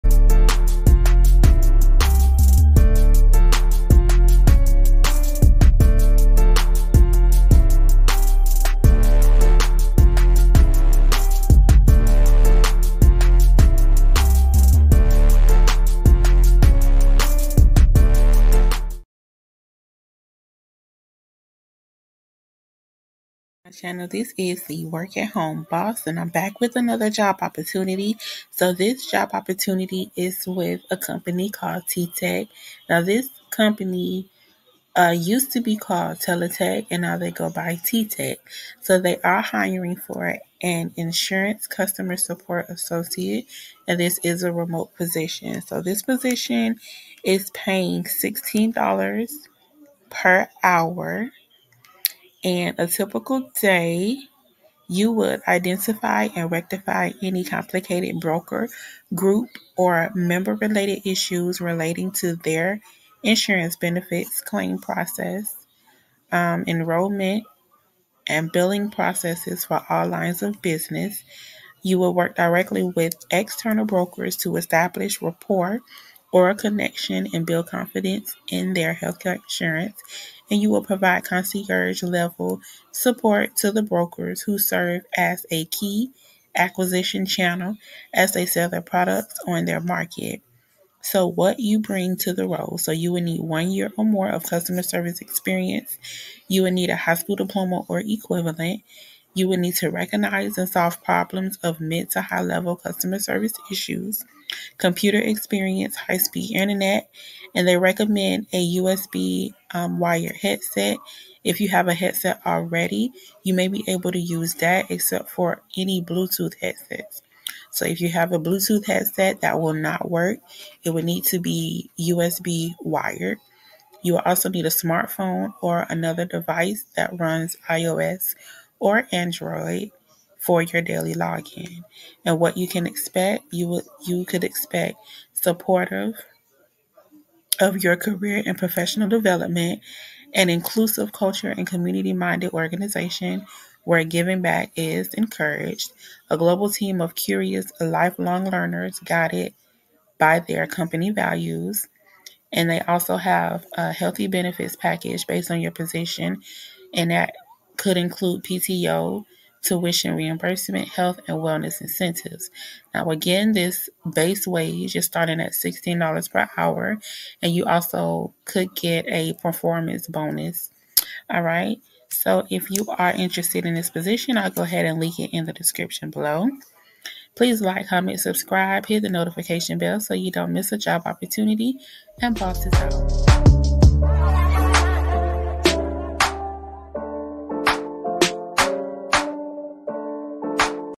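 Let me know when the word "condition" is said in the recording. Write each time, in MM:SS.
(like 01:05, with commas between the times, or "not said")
not said.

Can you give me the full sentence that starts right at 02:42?
Now, again, this base wage is starting at $16 per hour, and you also could get a performance bonus.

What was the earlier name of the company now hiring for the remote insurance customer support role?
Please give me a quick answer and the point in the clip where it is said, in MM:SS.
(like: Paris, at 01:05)
Teletech, at 00:36.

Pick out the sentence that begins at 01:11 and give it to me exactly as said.
You will work directly with external brokers to establish rapport or a connection and build confidence in their healthcare insurance.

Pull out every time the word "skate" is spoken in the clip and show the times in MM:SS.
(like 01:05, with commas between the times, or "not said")
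not said.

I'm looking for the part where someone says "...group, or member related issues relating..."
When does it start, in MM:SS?
00:59.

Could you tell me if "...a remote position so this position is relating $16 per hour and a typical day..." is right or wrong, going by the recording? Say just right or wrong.
wrong.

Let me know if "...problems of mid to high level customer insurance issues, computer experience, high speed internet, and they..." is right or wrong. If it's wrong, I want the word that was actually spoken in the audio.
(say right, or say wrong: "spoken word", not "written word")
wrong: "service", not "insurance".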